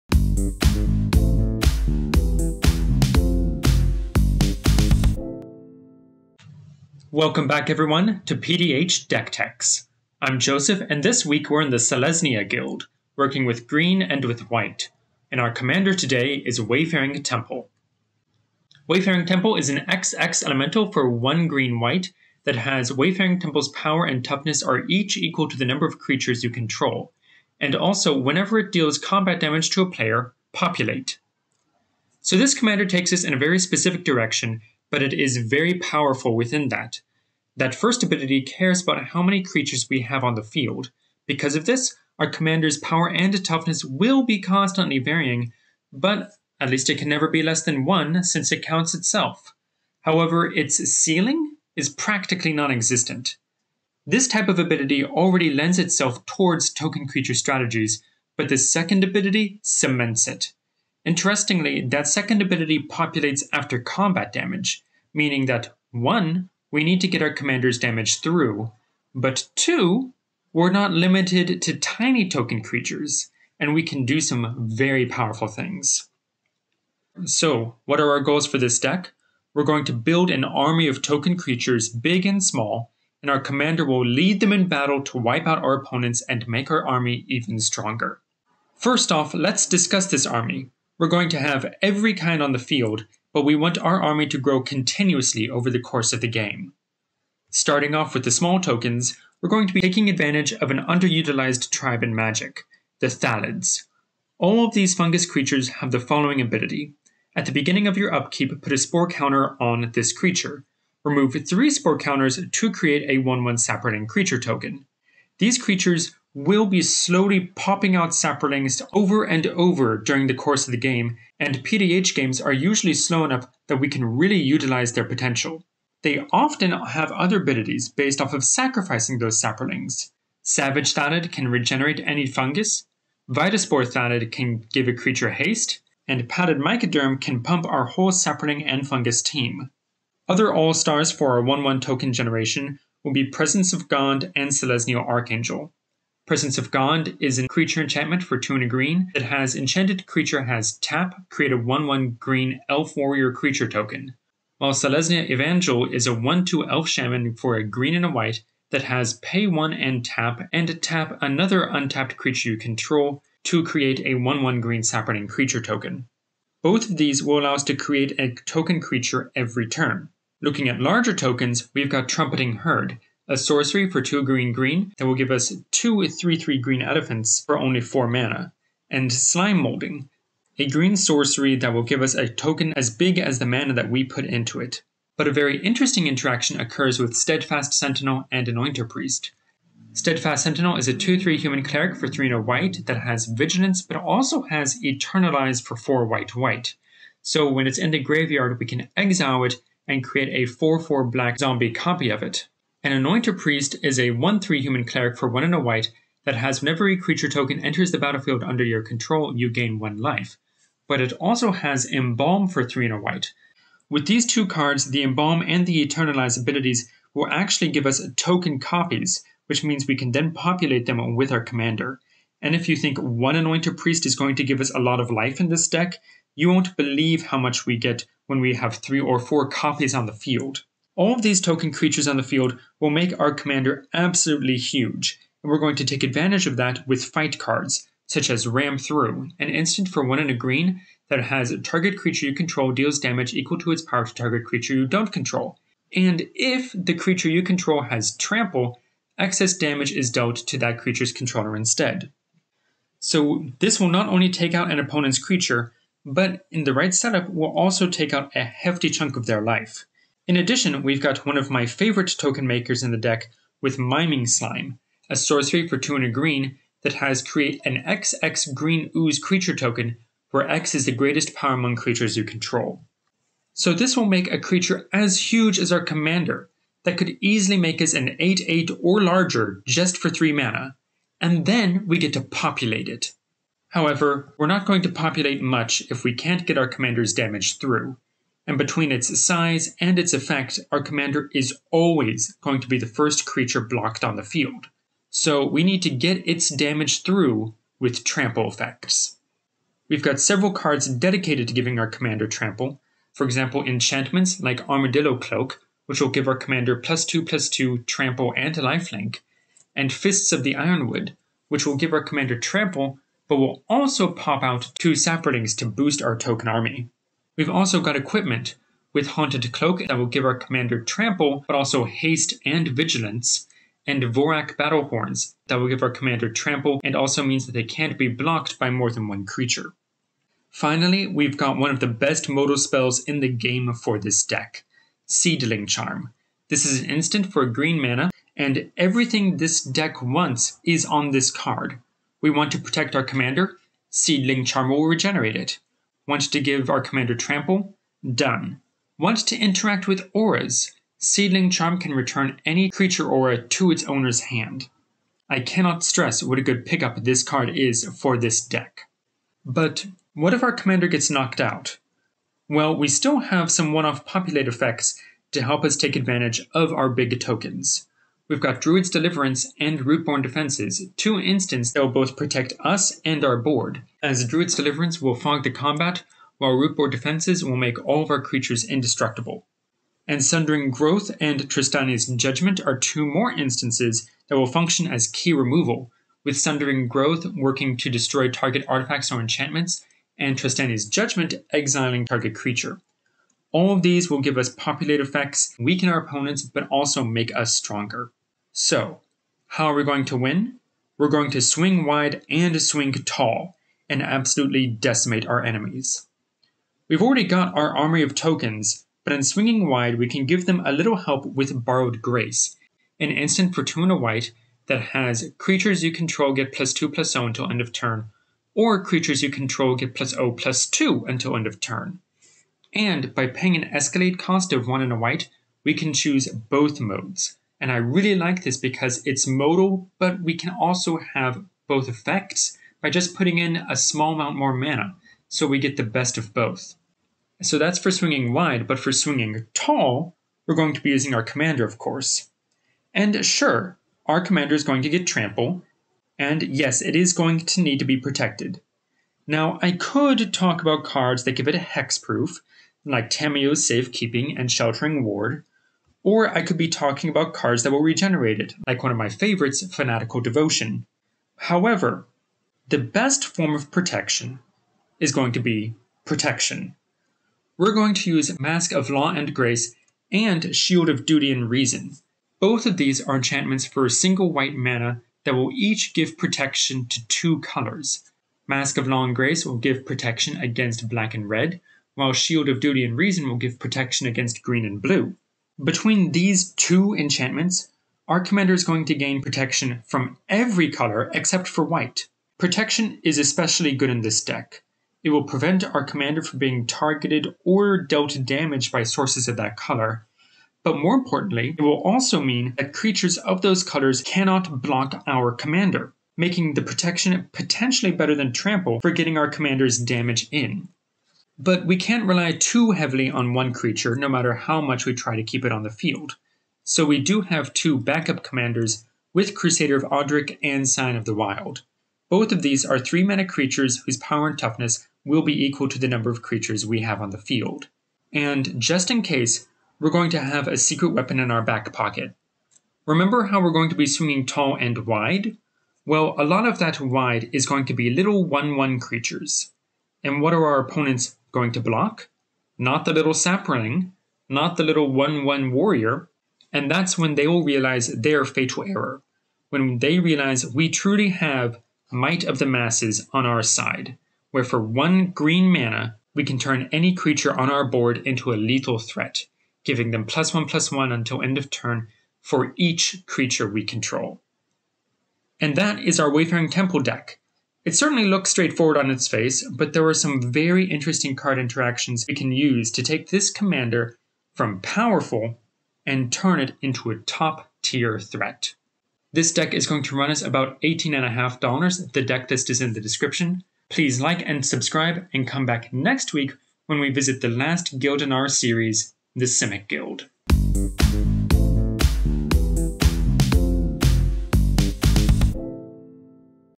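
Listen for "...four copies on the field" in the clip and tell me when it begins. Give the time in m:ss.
3:49.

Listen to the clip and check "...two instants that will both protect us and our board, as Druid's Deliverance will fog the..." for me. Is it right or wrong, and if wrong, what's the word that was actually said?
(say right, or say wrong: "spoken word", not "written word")
right.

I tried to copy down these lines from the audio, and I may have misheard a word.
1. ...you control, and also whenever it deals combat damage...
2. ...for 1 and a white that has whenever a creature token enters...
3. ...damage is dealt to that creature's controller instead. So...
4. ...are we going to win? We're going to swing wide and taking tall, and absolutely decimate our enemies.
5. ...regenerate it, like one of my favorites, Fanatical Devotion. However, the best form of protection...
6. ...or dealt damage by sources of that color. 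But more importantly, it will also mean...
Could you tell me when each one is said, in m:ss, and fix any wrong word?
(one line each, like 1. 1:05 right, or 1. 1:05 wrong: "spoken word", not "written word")
1. 0:26 right
2. 3:25 right
3. 4:09 right
4. 6:39 wrong: "swing", not "taking"
5. 7:37 right
6. 8:17 right.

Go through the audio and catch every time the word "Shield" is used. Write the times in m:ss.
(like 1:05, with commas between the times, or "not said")
7:50, 8:02.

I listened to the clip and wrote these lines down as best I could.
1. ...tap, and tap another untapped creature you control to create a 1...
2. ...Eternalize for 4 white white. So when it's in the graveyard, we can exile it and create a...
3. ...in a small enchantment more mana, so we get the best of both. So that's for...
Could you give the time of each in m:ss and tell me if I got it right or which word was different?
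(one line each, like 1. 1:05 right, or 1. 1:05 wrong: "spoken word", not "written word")
1. 2:40 right
2. 3:14 right
3. 7:13 wrong: "amount", not "enchantment".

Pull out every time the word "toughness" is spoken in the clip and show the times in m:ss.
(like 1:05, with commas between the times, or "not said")
0:24, 0:43, 8:44.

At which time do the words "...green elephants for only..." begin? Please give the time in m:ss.
2:56.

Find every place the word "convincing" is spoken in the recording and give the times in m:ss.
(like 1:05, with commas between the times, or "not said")
not said.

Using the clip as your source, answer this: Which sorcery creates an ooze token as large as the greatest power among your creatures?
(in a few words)
Miming Slime.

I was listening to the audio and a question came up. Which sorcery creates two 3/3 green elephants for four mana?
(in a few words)
Trumpeting Herd.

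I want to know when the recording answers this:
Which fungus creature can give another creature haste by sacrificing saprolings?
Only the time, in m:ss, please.
2:13.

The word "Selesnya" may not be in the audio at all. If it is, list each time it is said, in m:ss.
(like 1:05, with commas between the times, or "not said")
0:11, 2:24, 2:34.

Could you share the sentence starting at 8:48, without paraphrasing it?
And just in case, we're going to have a secret weapon in our back pocket.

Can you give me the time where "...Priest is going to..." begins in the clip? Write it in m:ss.
3:43.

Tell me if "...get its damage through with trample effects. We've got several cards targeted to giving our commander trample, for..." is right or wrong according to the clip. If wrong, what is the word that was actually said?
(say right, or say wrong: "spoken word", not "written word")
wrong: "dedicated", not "targeted".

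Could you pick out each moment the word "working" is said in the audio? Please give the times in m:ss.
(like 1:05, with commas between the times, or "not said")
0:13, 6:27.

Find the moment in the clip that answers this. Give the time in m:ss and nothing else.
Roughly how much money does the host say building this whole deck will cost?
9:40.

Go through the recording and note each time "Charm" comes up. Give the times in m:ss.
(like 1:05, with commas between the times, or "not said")
5:35, 5:44, 5:51.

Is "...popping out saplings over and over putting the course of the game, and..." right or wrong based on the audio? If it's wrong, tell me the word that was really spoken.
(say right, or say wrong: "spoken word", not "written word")
wrong: "during", not "putting".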